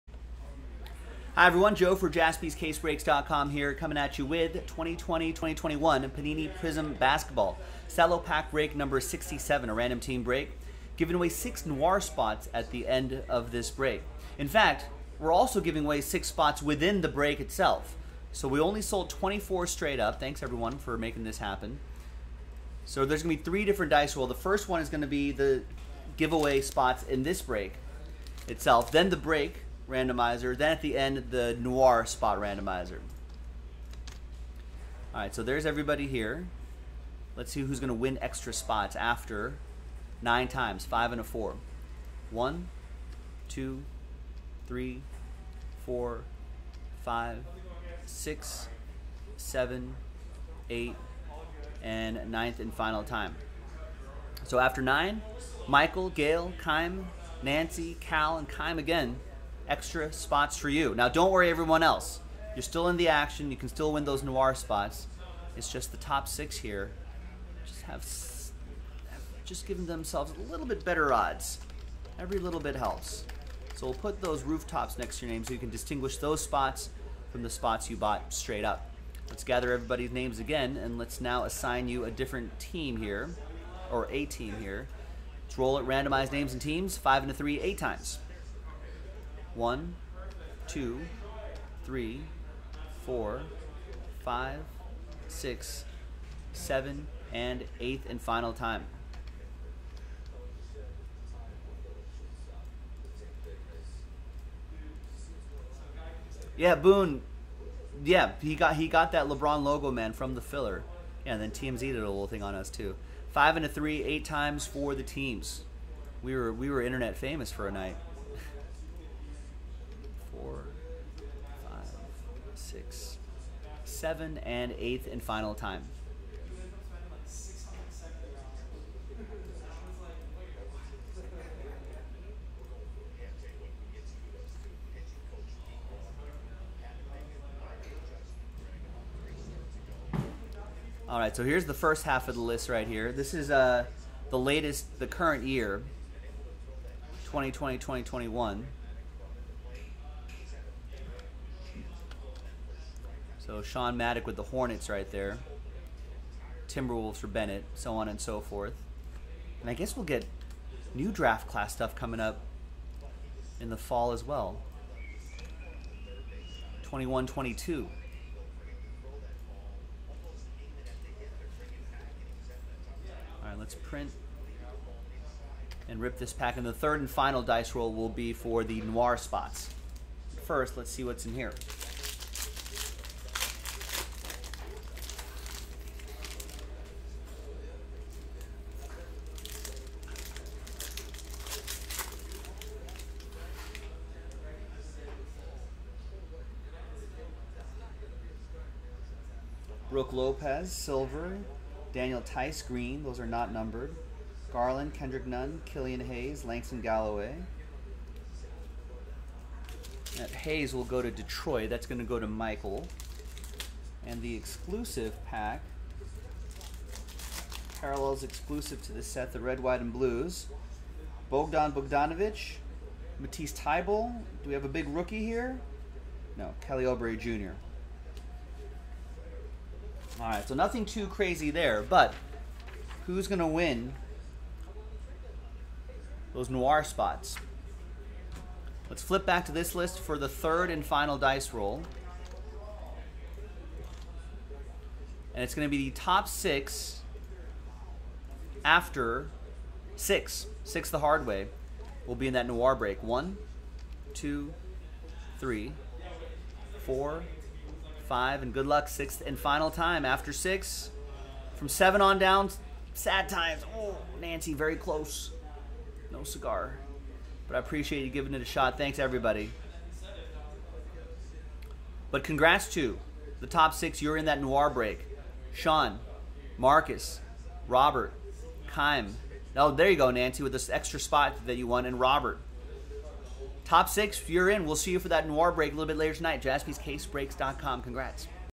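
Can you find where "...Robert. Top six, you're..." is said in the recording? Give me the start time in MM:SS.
04:41.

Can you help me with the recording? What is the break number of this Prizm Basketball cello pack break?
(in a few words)
67.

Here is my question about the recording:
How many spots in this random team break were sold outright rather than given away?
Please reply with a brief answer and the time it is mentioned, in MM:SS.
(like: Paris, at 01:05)
24, at 00:19.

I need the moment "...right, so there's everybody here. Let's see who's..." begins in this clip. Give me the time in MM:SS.
00:35.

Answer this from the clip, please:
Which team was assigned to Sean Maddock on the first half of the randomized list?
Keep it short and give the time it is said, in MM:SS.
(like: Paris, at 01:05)
Hornets, at 02:34.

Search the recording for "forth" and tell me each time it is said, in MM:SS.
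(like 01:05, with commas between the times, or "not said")
02:38.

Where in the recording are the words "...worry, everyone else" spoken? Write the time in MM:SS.
01:01.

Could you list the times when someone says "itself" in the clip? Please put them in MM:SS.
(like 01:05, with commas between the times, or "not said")
00:17, 00:28.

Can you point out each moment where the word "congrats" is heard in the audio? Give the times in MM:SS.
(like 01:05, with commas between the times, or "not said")
04:32, 04:47.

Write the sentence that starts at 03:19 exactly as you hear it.
Brook Lopez, Silver, Daniel Theis, Green.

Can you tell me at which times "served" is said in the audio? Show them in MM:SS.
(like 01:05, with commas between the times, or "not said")
not said.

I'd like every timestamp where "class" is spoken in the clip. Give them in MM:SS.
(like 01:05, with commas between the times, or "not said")
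02:41.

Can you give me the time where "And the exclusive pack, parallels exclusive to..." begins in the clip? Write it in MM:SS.
03:34.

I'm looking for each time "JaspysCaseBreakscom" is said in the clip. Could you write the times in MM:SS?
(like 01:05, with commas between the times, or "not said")
00:02, 04:46.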